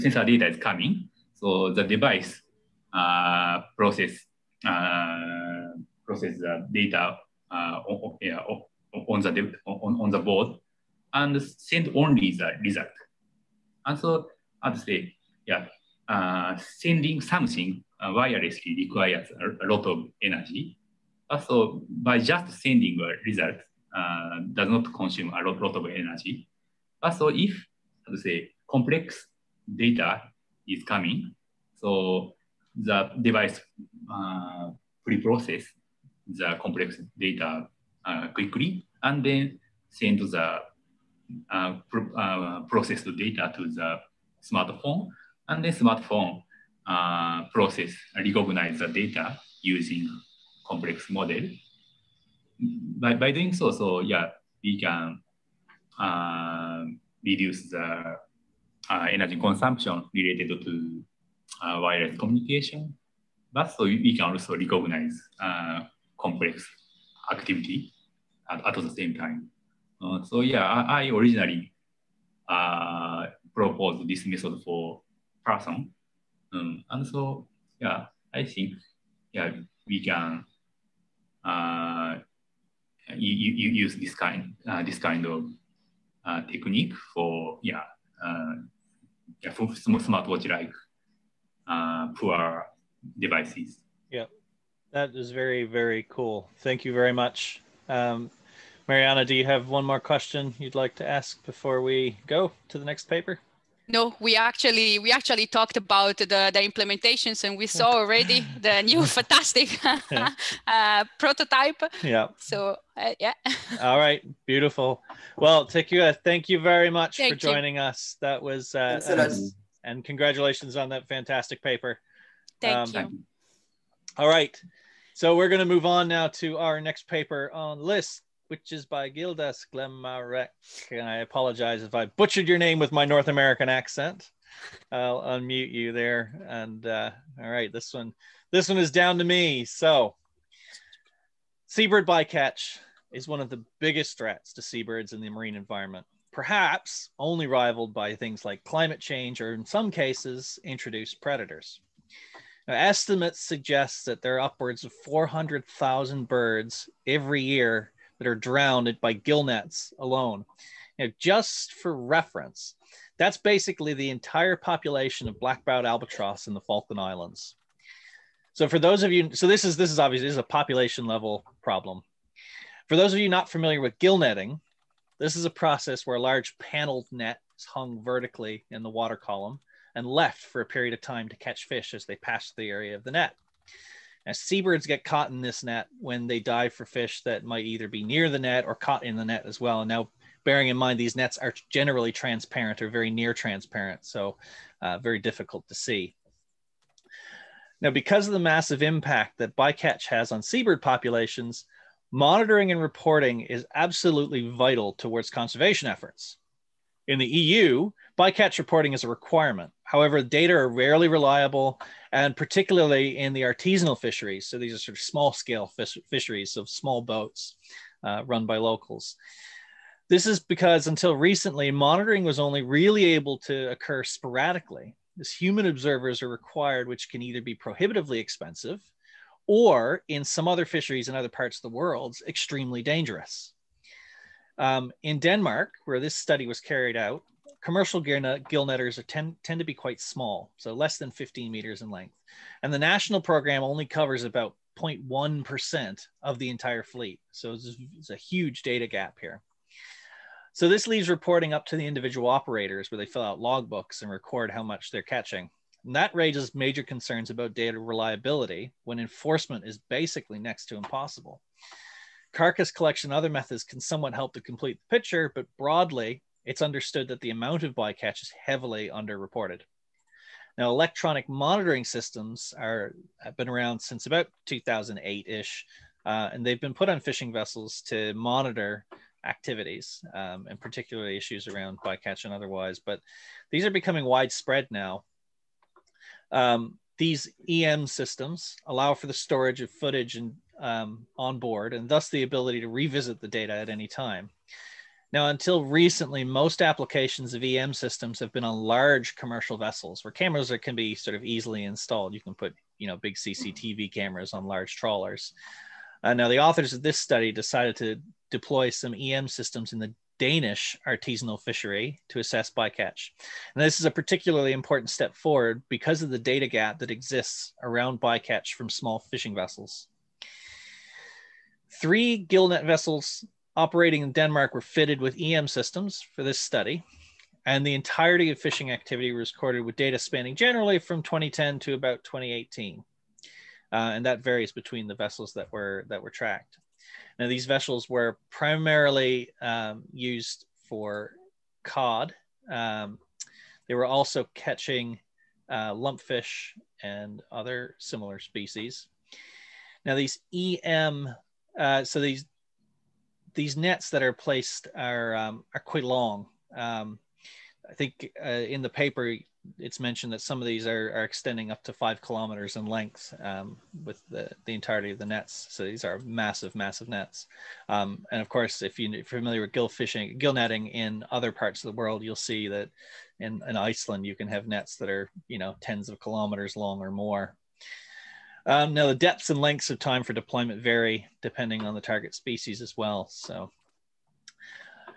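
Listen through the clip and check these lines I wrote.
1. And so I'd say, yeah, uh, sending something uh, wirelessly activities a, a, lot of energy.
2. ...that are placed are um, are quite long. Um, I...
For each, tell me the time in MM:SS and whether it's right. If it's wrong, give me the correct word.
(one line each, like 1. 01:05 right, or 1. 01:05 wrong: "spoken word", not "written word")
1. 00:13 wrong: "requires", not "activities"
2. 05:53 right.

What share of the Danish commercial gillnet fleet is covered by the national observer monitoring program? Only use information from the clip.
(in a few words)
0.1%.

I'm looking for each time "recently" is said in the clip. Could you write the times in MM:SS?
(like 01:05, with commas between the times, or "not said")
03:41, 04:55.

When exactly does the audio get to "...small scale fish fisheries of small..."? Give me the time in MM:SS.
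03:35.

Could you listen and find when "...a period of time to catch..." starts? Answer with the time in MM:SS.
03:00.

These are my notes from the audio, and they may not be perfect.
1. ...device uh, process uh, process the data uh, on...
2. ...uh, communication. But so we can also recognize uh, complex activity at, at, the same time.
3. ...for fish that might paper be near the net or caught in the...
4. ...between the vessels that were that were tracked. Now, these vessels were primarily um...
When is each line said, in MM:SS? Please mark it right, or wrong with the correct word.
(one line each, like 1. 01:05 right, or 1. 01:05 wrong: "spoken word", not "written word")
1. 00:01 right
2. 01:02 right
3. 03:06 wrong: "either", not "paper"
4. 05:34 right.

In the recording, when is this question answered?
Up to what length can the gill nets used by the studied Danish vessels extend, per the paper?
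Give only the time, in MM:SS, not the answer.
06:01.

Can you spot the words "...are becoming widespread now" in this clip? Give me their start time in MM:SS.
04:43.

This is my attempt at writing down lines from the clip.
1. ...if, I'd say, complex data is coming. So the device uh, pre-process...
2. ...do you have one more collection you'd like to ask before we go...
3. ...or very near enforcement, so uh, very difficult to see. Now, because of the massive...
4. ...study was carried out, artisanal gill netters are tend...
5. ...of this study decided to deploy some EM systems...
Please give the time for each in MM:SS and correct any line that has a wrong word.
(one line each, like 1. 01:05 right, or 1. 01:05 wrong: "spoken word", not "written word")
1. 00:27 right
2. 01:39 wrong: "question", not "collection"
3. 03:12 wrong: "transparent", not "enforcement"
4. 03:56 wrong: "commercial", not "artisanal"
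5. 05:06 right.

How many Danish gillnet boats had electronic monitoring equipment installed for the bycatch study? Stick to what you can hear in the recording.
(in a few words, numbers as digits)
3.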